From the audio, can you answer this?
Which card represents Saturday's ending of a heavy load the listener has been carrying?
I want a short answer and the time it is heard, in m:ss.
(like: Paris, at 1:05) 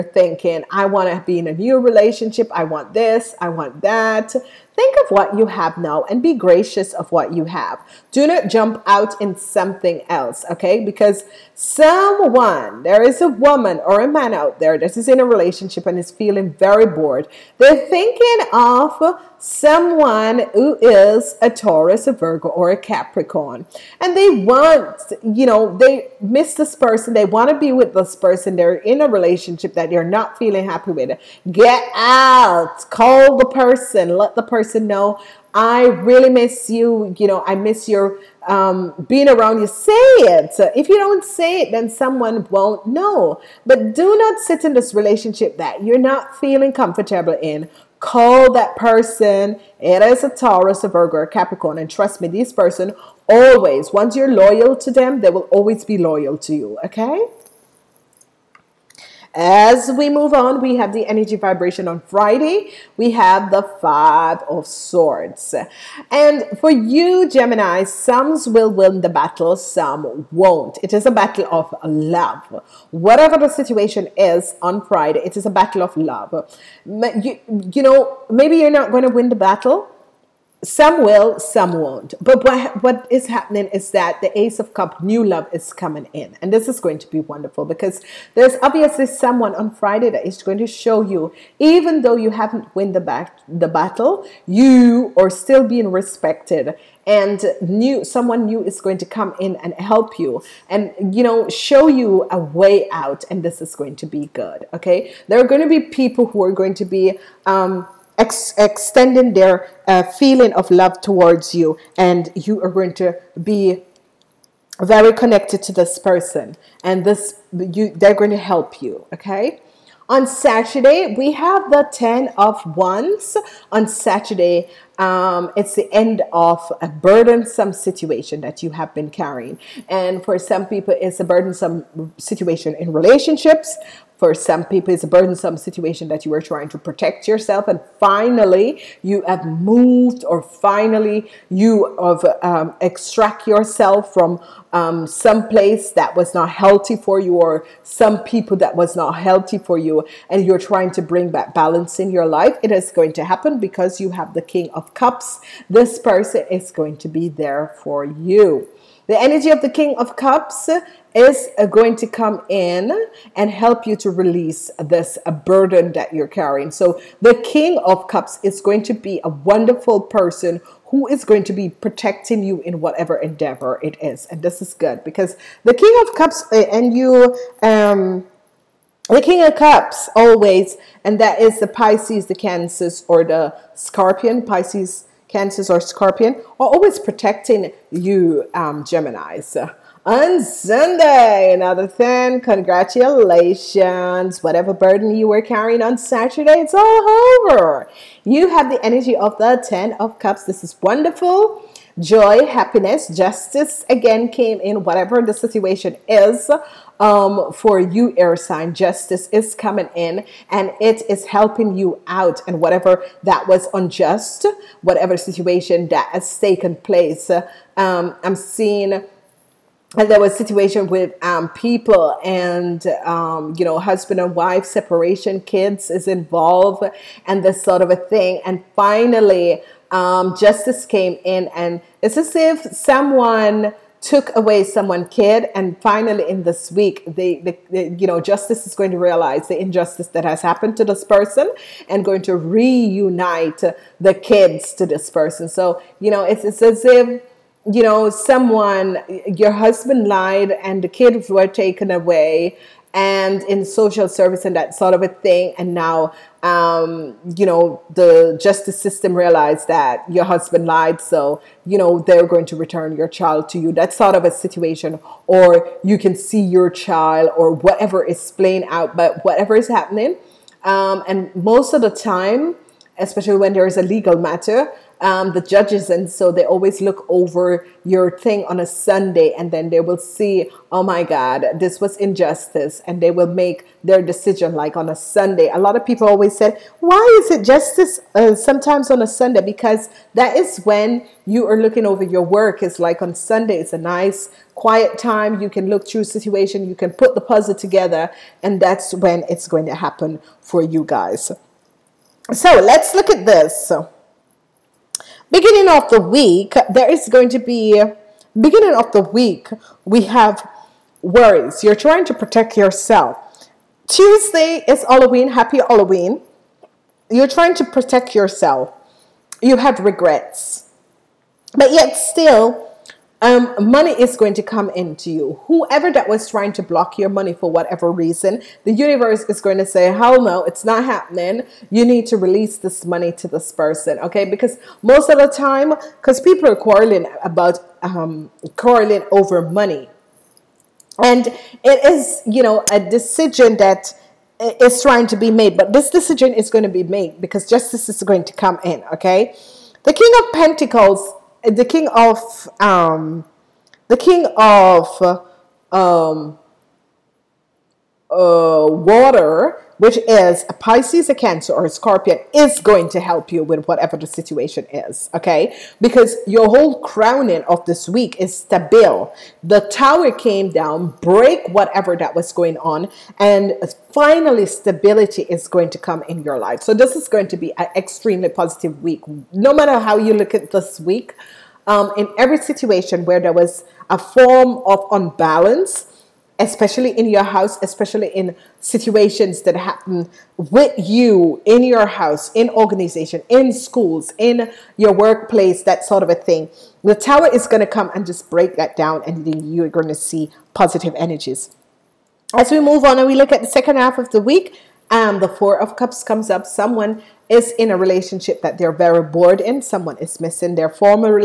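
10 of Wands, at 2:01.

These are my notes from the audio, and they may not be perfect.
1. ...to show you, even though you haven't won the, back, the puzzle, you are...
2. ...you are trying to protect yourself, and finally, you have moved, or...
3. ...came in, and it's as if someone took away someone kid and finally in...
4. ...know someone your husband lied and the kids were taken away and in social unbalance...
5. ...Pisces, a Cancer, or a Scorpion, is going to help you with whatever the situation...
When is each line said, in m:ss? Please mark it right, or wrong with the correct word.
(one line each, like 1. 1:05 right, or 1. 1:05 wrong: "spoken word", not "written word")
1. 1:30 wrong: "battle", not "puzzle"
2. 2:16 right
3. 3:50 right
4. 4:07 wrong: "service", not "unbalance"
5. 6:00 right.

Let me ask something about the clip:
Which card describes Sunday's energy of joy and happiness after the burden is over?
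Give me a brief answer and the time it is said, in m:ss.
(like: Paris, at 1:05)
Ten of Cups, at 3:19.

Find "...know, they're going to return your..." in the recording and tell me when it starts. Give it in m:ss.
4:21.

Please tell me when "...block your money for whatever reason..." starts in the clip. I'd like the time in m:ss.
5:26.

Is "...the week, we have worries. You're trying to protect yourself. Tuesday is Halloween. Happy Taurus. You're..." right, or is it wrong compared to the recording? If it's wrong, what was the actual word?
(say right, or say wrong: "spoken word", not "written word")
wrong: "Halloween", not "Taurus".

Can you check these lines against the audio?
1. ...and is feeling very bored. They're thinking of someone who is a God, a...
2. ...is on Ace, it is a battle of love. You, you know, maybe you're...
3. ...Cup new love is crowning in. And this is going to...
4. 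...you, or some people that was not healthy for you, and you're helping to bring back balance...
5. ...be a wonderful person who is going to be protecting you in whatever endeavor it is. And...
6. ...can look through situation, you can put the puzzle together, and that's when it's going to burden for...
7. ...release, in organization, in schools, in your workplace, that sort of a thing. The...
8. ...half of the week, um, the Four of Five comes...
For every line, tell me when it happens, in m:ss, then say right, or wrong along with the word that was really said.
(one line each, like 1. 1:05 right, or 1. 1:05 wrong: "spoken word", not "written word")
1. 0:15 wrong: "Taurus", not "God"
2. 1:14 wrong: "Friday", not "Ace"
3. 1:24 wrong: "coming", not "crowning"
4. 2:27 wrong: "trying", not "helping"
5. 2:48 right
6. 4:55 wrong: "happen", not "burden"
7. 6:31 wrong: "house", not "release"
8. 6:43 wrong: "Cups", not "Five".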